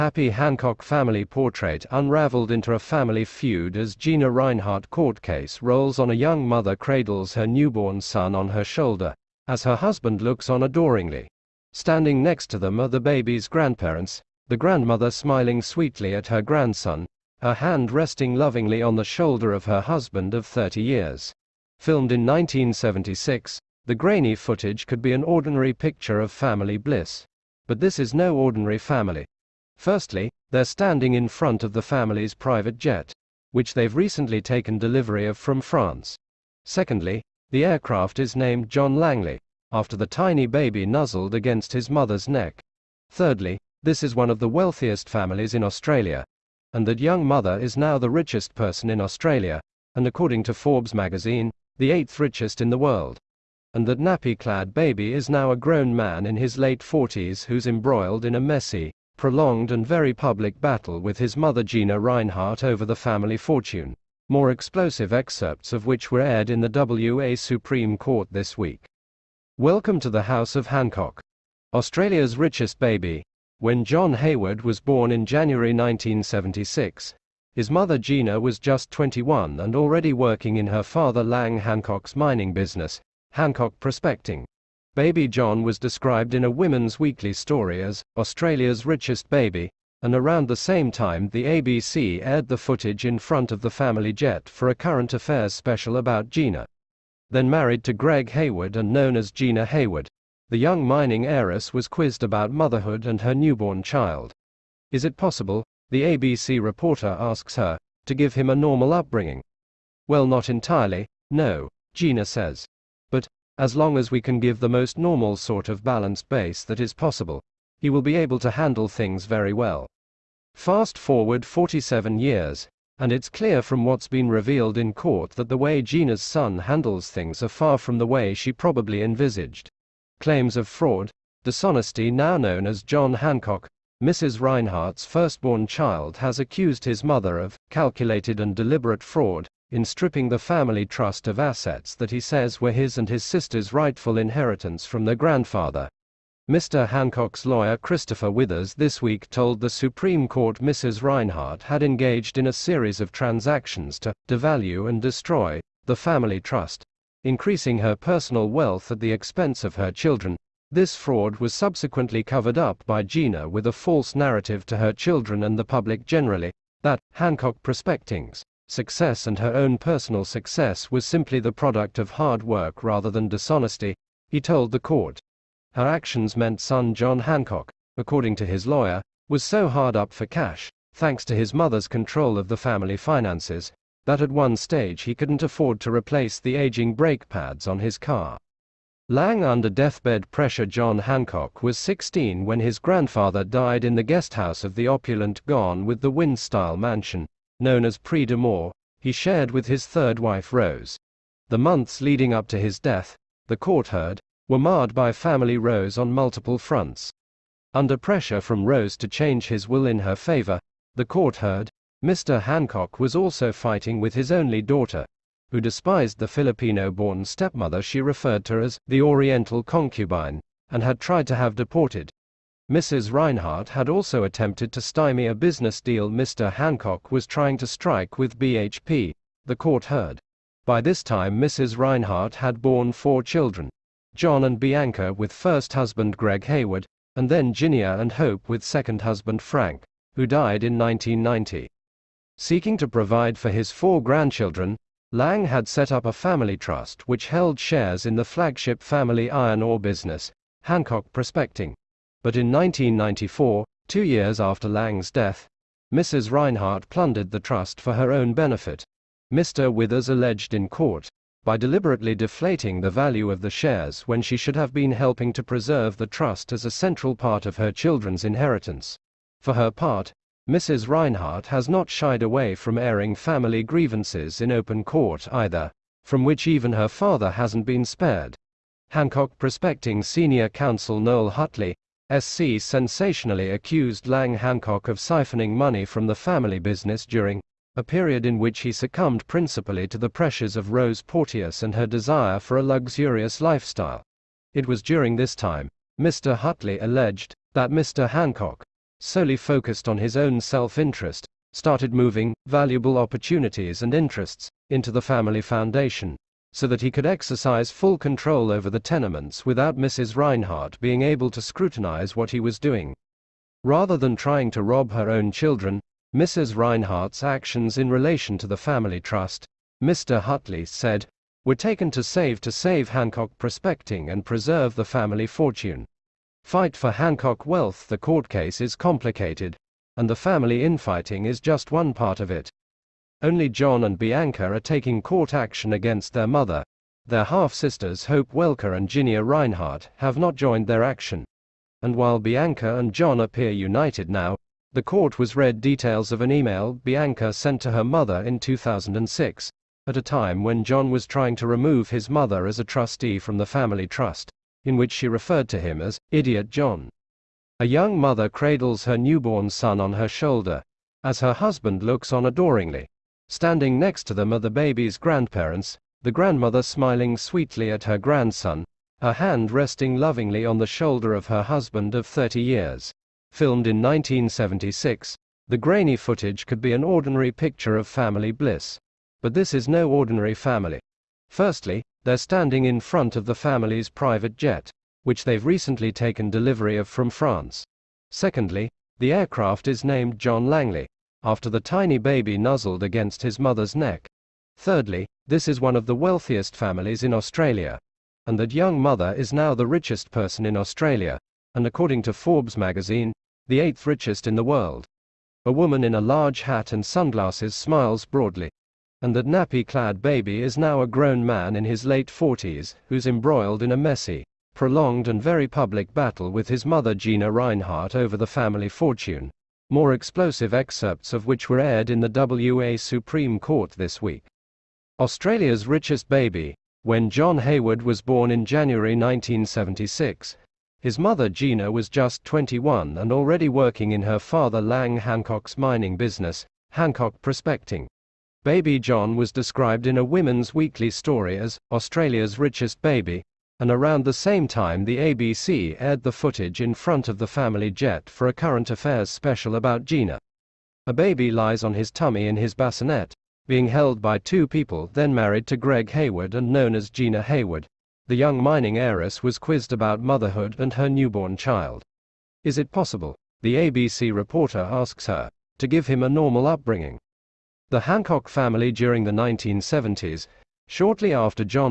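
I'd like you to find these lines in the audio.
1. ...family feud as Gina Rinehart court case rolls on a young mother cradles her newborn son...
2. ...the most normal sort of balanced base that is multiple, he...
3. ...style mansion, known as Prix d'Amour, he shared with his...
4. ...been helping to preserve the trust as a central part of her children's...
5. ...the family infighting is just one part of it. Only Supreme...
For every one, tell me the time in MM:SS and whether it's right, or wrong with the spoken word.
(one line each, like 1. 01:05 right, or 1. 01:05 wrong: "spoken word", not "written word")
1. 00:02 right
2. 01:54 wrong: "possible", not "multiple"
3. 03:16 right
4. 04:24 right
5. 05:30 wrong: "John", not "Supreme".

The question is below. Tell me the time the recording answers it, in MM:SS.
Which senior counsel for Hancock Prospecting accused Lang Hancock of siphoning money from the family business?
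04:40.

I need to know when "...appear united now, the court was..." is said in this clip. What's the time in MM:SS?
05:43.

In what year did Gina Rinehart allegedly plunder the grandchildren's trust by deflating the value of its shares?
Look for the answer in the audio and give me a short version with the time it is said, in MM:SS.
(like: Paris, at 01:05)
1994, at 04:12.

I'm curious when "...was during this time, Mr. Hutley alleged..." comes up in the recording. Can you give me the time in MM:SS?
04:54.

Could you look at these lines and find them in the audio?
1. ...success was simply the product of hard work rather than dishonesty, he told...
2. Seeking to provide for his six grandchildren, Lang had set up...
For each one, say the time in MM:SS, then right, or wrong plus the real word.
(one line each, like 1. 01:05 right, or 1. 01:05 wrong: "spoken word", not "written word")
1. 02:50 right
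2. 04:02 wrong: "four", not "six".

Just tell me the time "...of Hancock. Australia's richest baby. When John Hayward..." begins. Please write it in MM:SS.
01:10.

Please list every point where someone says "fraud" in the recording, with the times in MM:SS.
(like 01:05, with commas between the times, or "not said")
02:10, 02:19, 02:40.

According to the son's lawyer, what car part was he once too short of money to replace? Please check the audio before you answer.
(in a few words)
Brake pads.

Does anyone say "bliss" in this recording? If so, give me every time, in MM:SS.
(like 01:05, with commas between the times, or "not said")
00:26, 06:18.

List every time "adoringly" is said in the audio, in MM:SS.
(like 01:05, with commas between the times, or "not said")
00:10, 06:02.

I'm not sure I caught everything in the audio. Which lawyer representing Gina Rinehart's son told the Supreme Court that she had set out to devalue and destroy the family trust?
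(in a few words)
Christopher Withers.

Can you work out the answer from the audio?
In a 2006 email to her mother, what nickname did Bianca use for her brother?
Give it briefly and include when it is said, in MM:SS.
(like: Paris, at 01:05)
Idiot John, at 05:56.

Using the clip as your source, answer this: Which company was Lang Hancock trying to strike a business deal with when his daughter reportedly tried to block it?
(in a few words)
BHP.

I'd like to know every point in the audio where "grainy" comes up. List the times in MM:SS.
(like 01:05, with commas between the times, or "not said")
00:23, 06:15.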